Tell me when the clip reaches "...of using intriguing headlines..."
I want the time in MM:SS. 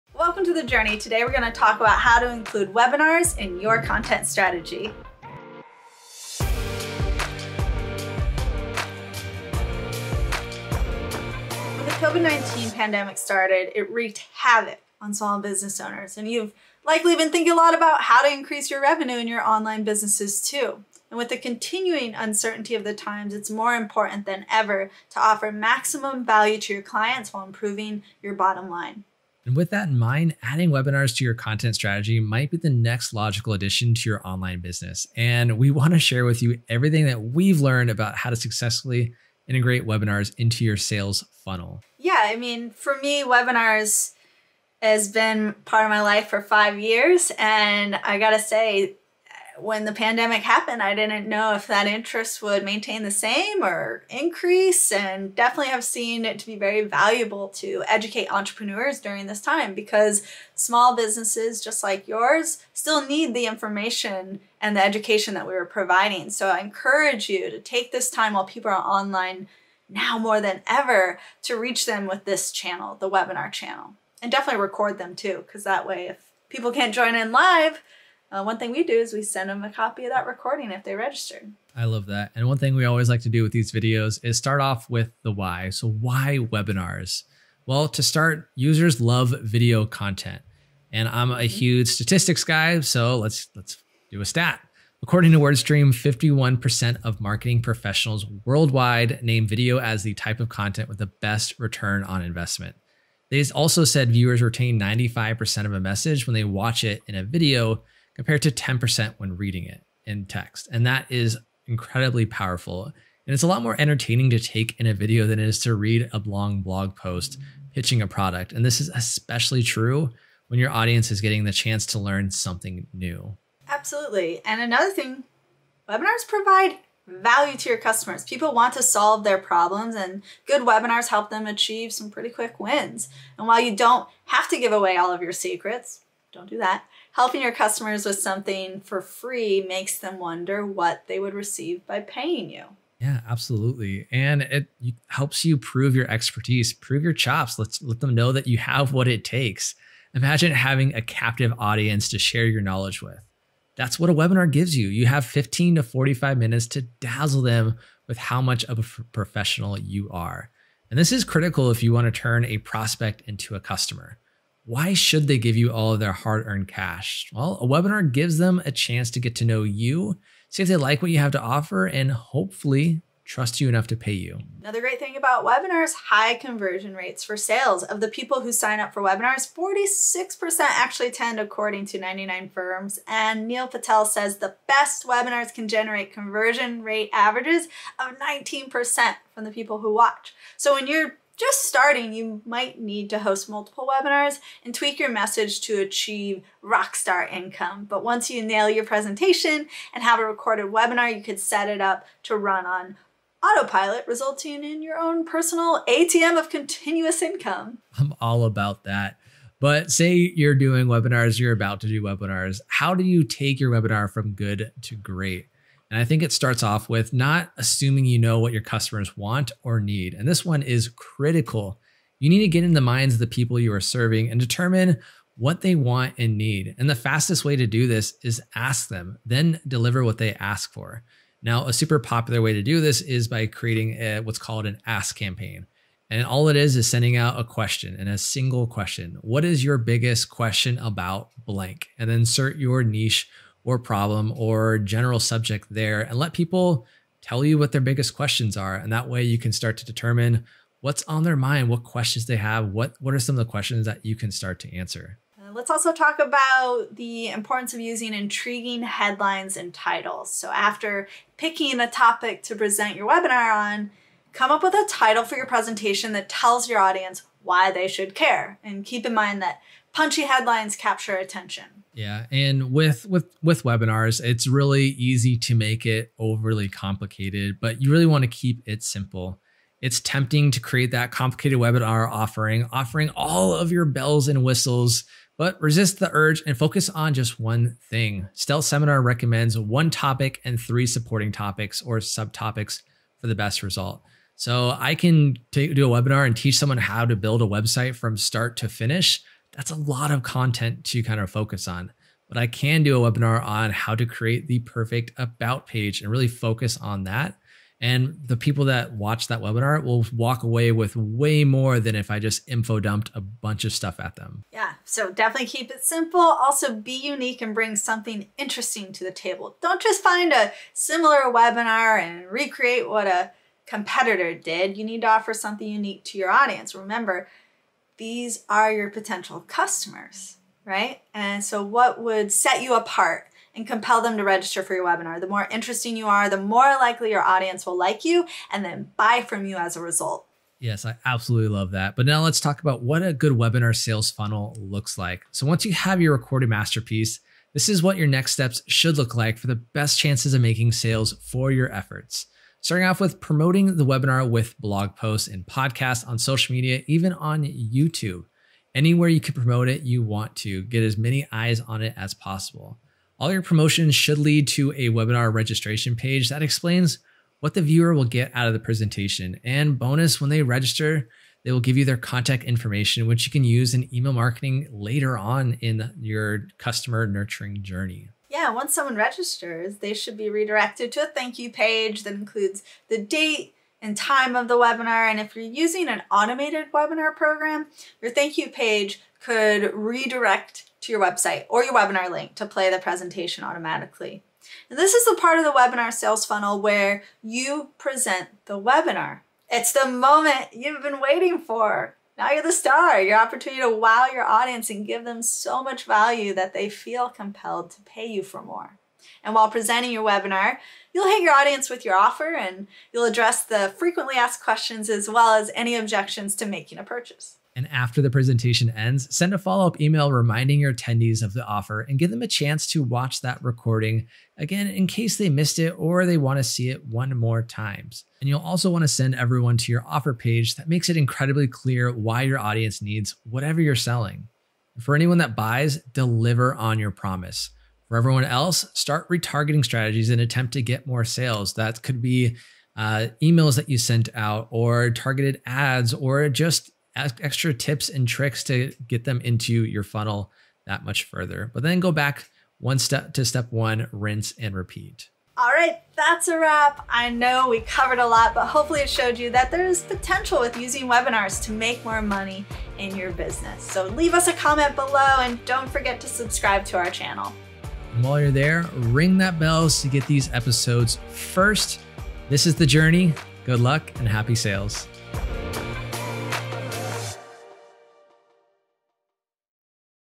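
04:17.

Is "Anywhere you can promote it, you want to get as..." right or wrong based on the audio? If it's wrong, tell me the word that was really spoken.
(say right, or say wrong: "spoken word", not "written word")
right.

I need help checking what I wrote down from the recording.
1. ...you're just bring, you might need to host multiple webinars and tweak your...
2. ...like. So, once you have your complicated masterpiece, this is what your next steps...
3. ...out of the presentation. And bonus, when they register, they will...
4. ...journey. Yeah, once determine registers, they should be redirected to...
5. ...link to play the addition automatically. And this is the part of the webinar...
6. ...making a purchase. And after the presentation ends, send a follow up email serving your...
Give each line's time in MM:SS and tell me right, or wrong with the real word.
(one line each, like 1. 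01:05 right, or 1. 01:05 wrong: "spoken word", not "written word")
1. 03:10 wrong: "starting", not "bring"
2. 05:44 wrong: "recorded", not "complicated"
3. 06:08 right
4. 06:17 wrong: "someone", not "determine"
5. 06:32 wrong: "presentation", not "addition"
6. 06:56 wrong: "reminding", not "serving".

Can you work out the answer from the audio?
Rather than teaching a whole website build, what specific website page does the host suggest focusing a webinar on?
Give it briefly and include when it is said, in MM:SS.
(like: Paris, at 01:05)
about page, at 05:05.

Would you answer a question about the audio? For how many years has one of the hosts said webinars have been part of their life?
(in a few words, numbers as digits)
5.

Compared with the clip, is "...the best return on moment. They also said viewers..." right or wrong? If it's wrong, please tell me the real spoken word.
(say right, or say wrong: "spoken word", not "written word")
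wrong: "investment", not "moment".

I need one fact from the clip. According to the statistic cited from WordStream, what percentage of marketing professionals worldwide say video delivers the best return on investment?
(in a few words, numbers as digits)
51%.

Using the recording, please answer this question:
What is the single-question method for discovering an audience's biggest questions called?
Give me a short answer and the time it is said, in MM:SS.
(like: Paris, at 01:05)
ask campaign, at 03:54.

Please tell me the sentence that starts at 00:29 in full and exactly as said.
And with that in mind, adding webinars to your content strategy might be the next logical addition to your online business.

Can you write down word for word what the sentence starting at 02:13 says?
And while you don't have to give away all of your secrets, don't do that.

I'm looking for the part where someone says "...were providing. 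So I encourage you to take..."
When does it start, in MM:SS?
01:05.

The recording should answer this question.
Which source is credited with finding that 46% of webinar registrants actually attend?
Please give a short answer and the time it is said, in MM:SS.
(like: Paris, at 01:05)
99 firms, at 03:01.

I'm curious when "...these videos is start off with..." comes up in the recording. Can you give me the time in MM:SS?
01:23.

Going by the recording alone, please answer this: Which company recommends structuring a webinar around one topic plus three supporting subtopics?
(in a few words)
Stealth Seminar.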